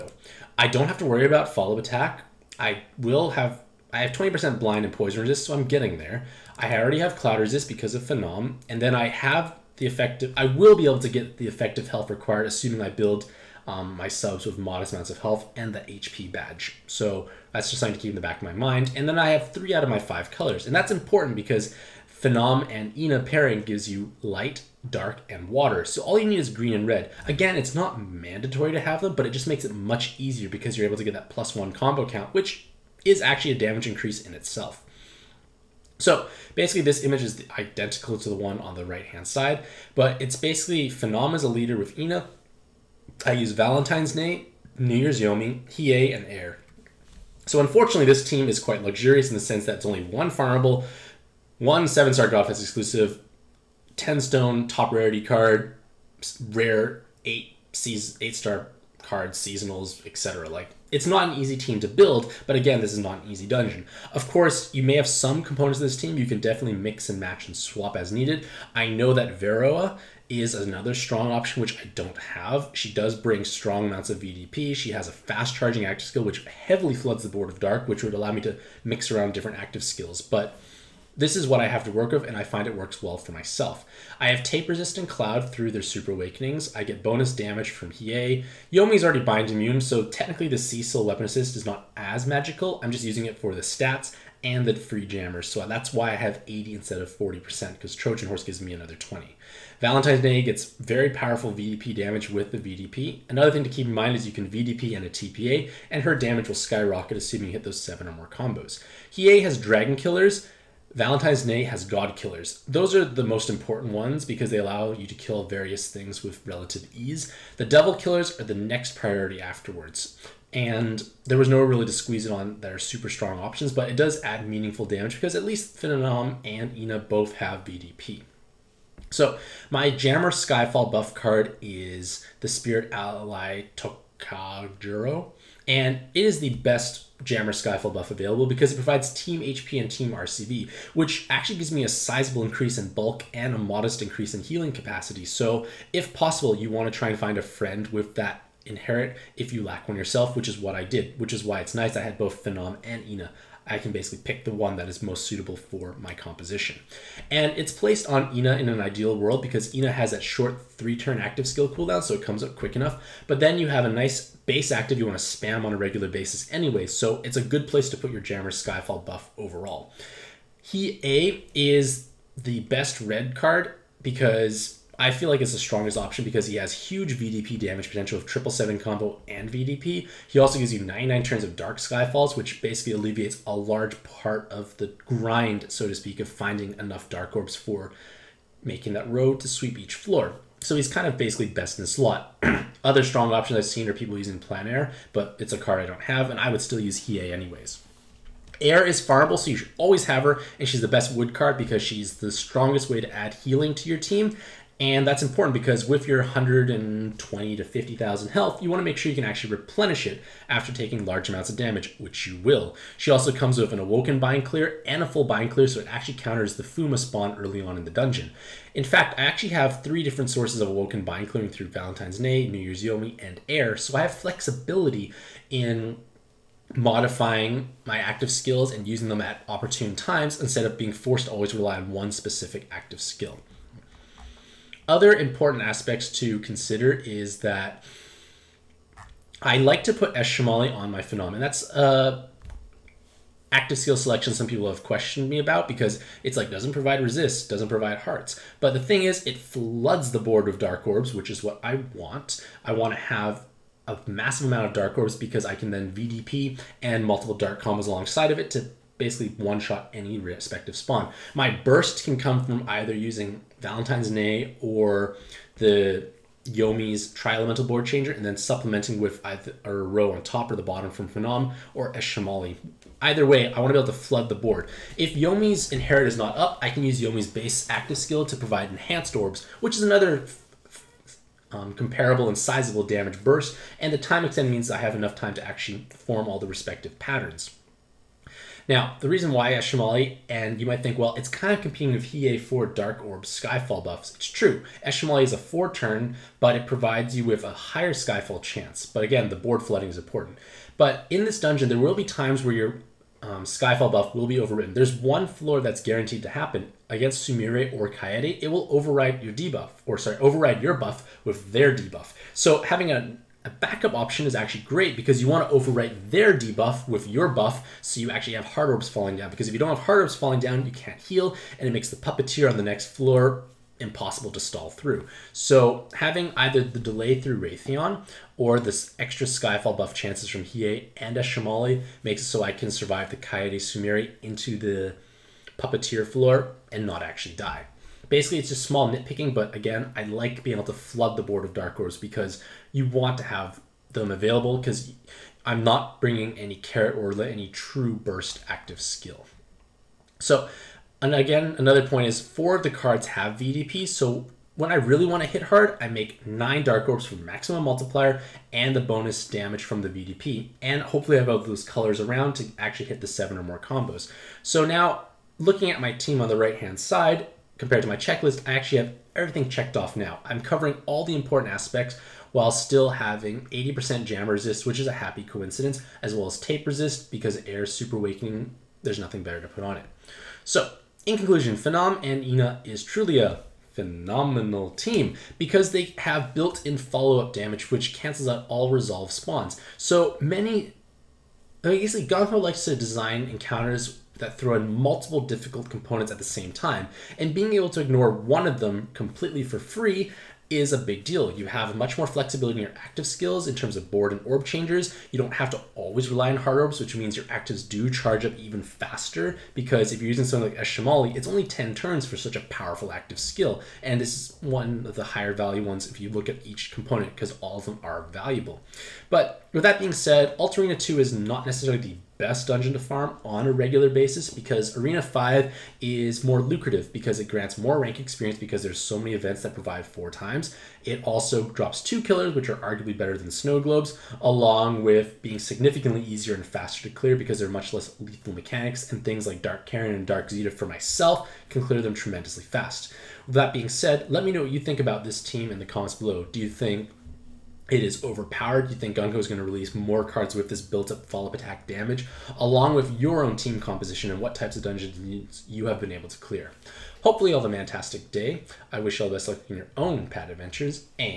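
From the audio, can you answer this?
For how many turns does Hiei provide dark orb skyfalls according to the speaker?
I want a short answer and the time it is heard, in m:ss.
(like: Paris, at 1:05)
99, at 3:00.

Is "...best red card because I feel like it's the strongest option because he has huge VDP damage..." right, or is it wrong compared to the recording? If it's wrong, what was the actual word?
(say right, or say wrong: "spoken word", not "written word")
right.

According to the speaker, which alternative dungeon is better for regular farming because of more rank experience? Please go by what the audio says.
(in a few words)
Arena 5.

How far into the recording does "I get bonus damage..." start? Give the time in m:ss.
1:26.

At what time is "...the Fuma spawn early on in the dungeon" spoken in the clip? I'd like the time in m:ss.
3:36.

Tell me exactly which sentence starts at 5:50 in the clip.
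So, and again, another point is four of the cards have VDP.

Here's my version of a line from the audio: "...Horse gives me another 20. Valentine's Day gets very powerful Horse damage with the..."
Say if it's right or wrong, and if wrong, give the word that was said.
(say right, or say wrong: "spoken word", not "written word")
wrong: "VDP", not "Horse".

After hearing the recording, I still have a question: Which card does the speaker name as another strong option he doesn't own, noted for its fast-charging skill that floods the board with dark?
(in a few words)
Veroa.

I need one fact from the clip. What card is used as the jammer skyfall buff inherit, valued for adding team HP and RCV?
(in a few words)
Spirit Ally Tokajuro.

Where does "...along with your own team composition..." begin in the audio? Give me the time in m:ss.
7:32.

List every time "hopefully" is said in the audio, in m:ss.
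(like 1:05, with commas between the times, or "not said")
6:00, 7:37.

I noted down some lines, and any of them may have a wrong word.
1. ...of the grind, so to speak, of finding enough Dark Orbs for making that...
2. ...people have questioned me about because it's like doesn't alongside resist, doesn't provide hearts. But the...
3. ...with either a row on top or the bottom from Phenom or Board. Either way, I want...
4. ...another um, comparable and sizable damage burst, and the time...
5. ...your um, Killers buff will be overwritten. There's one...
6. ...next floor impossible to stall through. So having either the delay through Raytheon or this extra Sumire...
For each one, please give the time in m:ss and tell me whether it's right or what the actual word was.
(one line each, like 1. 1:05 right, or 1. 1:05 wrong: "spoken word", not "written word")
1. 3:04 right
2. 4:04 wrong: "provide", not "alongside"
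3. 4:29 wrong: "Eshimali", not "Board"
4. 4:39 right
5. 5:02 wrong: "Skyfall", not "Killers"
6. 5:22 wrong: "Skyfall", not "Sumire".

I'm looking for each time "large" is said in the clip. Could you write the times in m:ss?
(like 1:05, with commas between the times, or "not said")
3:03, 3:31.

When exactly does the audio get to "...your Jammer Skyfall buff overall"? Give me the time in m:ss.
2:48.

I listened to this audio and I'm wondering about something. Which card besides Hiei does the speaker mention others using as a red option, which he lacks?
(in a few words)
Plan Air.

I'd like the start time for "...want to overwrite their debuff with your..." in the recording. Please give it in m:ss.
5:15.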